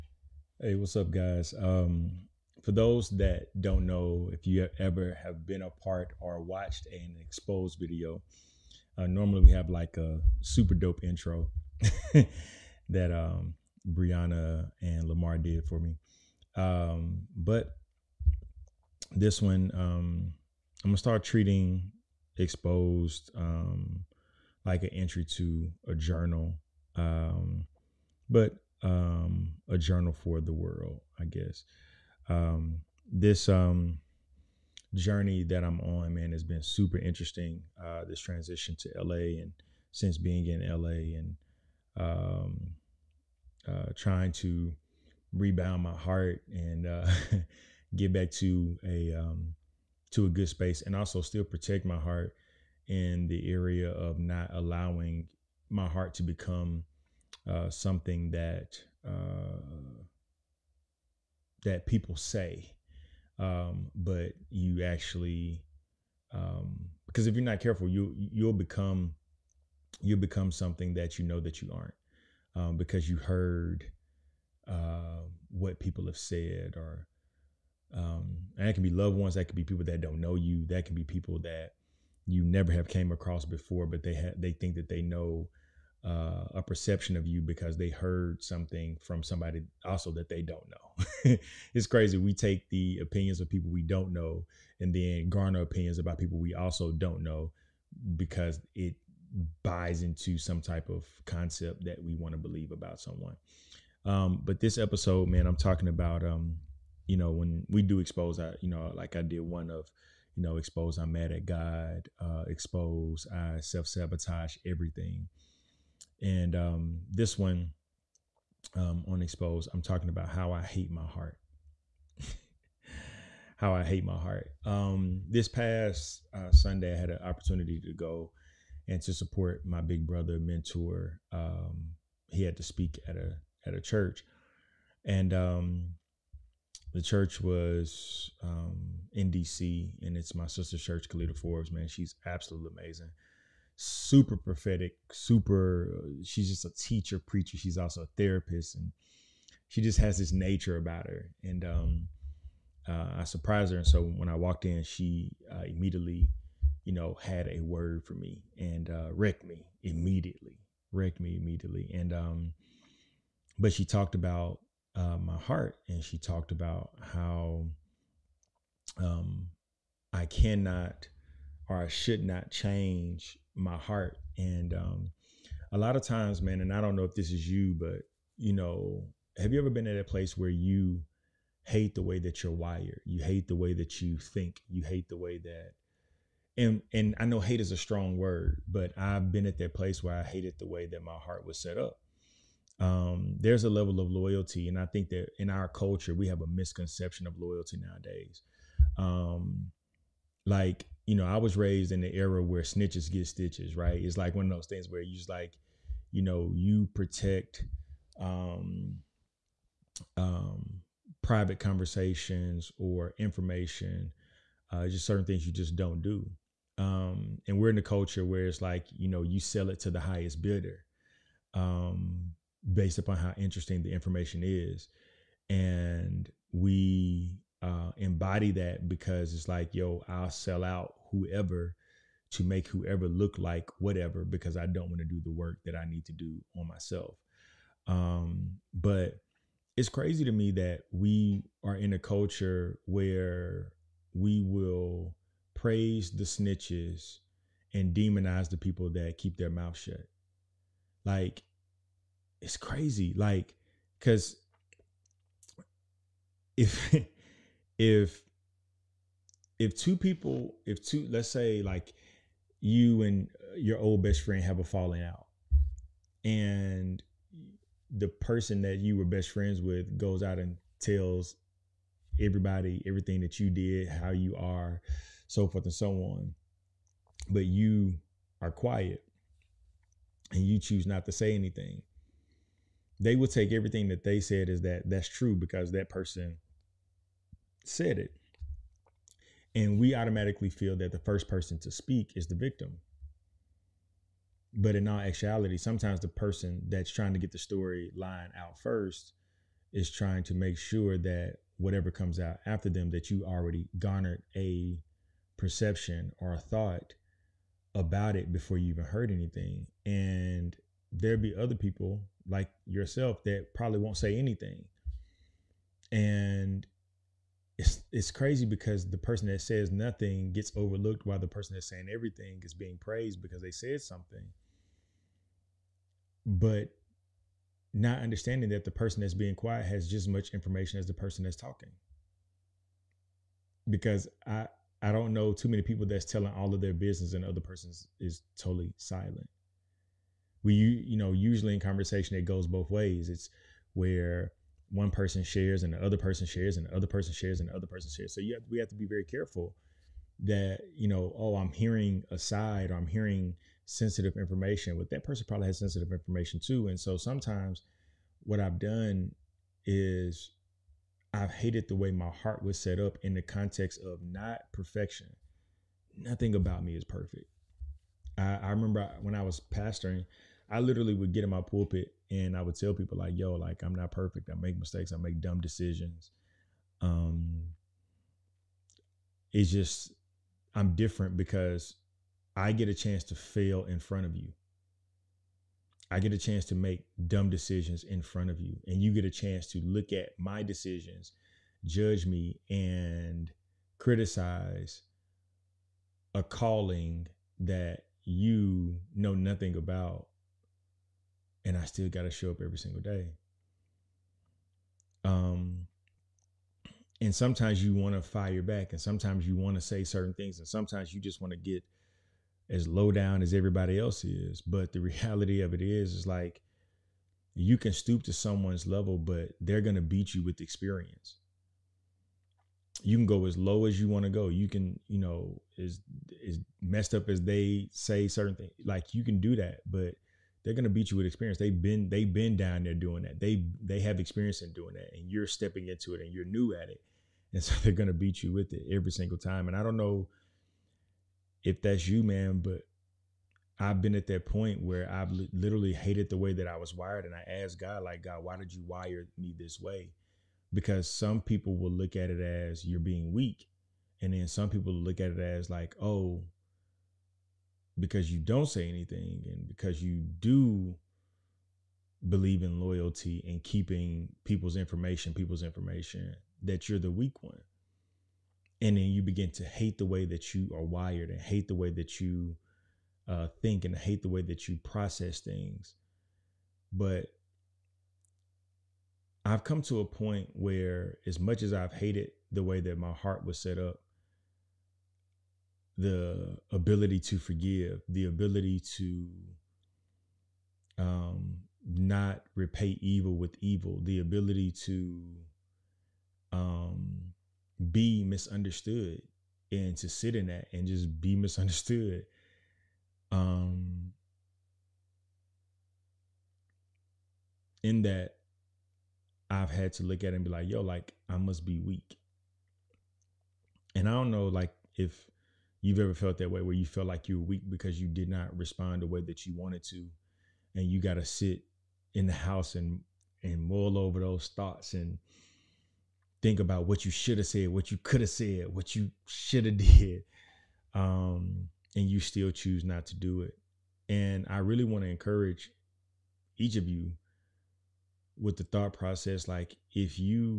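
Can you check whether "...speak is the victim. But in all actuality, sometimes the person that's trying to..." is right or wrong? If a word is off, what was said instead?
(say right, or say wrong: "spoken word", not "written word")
right.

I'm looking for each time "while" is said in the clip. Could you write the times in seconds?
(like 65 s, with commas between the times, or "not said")
321 s.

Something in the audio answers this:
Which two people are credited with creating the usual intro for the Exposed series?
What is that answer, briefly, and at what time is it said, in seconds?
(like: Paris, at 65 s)
Brianna and Lamar, at 13 s.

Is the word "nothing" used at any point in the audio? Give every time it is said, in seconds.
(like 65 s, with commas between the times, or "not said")
319 s, 365 s, 399 s.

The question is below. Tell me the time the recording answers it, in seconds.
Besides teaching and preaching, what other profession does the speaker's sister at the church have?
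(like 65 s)
148 s.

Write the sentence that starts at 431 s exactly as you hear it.
They've been they've been down there doing that.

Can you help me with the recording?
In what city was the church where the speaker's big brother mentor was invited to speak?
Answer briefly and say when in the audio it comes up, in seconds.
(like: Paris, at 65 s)
D.C., at 139 s.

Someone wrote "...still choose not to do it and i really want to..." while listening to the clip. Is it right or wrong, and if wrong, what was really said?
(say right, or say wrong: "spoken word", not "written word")
right.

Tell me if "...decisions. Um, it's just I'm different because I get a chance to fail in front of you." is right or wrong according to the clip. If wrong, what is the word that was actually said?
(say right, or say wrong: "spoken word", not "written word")
right.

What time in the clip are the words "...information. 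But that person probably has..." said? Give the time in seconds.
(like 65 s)
354 s.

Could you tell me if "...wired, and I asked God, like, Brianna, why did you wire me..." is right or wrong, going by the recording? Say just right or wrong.
wrong.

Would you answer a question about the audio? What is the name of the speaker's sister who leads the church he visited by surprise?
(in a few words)
Kalita Forbes.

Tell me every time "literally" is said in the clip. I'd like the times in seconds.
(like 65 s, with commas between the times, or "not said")
370 s, 445 s.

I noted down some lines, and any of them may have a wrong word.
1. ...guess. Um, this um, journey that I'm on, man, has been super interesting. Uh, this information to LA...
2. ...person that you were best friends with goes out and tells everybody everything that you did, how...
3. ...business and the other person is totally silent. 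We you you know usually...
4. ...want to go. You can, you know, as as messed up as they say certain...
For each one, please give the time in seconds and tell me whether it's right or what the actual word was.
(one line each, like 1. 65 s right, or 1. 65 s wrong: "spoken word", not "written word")
1. 31 s wrong: "transition", not "information"
2. 268 s right
3. 336 s right
4. 423 s right.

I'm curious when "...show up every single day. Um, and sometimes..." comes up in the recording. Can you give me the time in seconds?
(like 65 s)
402 s.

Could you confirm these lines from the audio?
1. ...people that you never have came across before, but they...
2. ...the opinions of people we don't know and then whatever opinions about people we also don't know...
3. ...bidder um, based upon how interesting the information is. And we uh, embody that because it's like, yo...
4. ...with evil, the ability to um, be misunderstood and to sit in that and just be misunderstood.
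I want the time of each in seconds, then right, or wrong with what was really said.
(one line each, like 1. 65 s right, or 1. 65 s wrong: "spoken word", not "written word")
1. 81 s right
2. 92 s wrong: "garner", not "whatever"
3. 220 s right
4. 493 s right.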